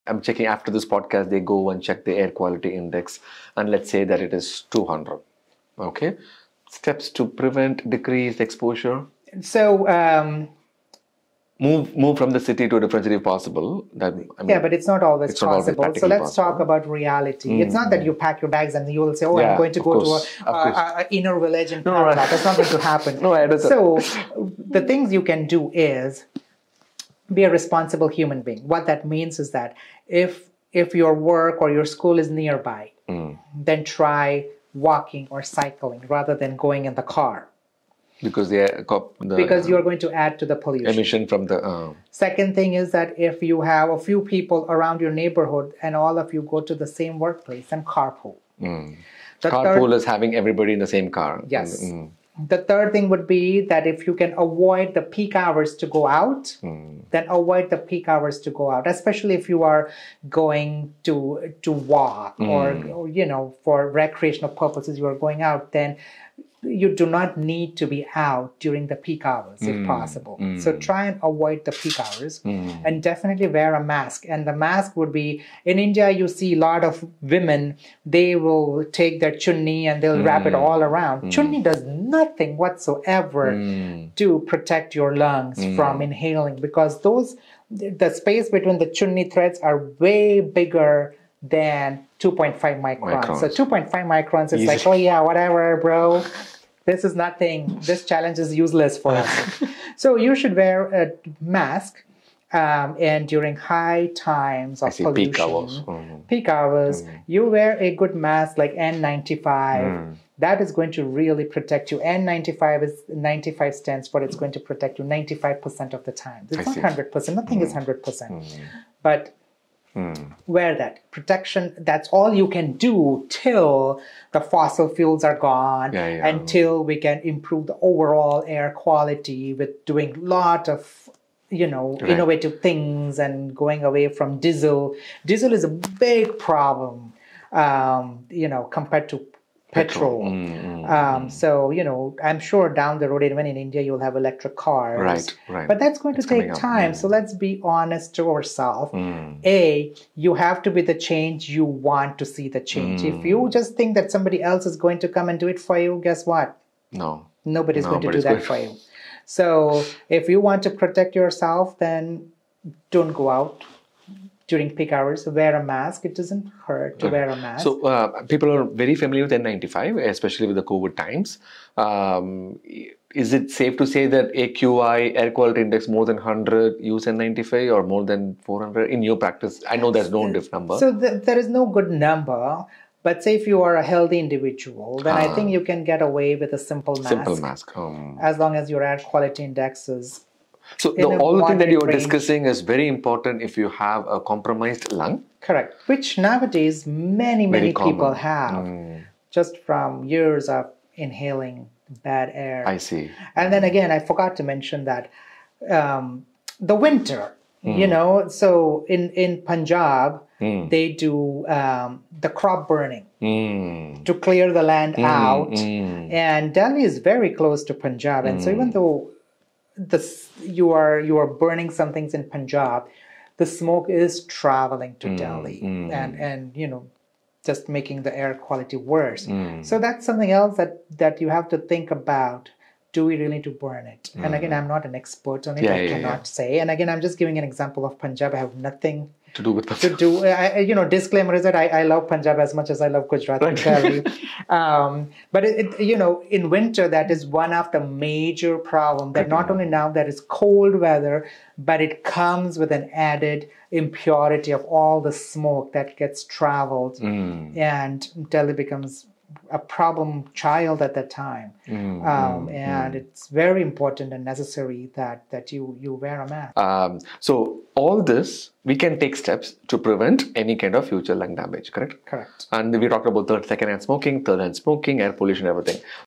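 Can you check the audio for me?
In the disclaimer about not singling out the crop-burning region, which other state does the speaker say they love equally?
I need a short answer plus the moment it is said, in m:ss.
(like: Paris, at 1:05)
Gujarat, at 4:03.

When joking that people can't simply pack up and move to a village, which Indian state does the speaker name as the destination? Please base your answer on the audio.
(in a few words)
Kerala.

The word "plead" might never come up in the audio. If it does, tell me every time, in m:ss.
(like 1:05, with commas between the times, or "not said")
not said.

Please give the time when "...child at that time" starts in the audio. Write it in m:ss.
4:20.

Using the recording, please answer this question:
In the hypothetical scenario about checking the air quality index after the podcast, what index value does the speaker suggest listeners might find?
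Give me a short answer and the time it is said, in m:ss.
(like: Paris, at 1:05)
200, at 0:04.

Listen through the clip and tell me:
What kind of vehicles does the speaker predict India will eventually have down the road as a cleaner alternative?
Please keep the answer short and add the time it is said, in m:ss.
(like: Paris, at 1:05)
Electric cars, at 2:24.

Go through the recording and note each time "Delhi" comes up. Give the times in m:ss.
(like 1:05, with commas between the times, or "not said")
3:36, 3:45, 4:18.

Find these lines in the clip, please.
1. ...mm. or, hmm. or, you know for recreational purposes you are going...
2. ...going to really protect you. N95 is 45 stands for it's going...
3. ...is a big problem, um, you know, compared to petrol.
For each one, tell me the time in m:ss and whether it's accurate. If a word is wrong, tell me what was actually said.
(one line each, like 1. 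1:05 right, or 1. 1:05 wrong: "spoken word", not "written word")
1. 1:02 right
2. 1:50 wrong: "95", not "45"
3. 2:15 right.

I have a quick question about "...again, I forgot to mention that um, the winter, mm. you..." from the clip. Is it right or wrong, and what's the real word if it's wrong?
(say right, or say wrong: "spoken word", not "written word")
right.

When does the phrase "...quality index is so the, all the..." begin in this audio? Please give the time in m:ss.
3:08.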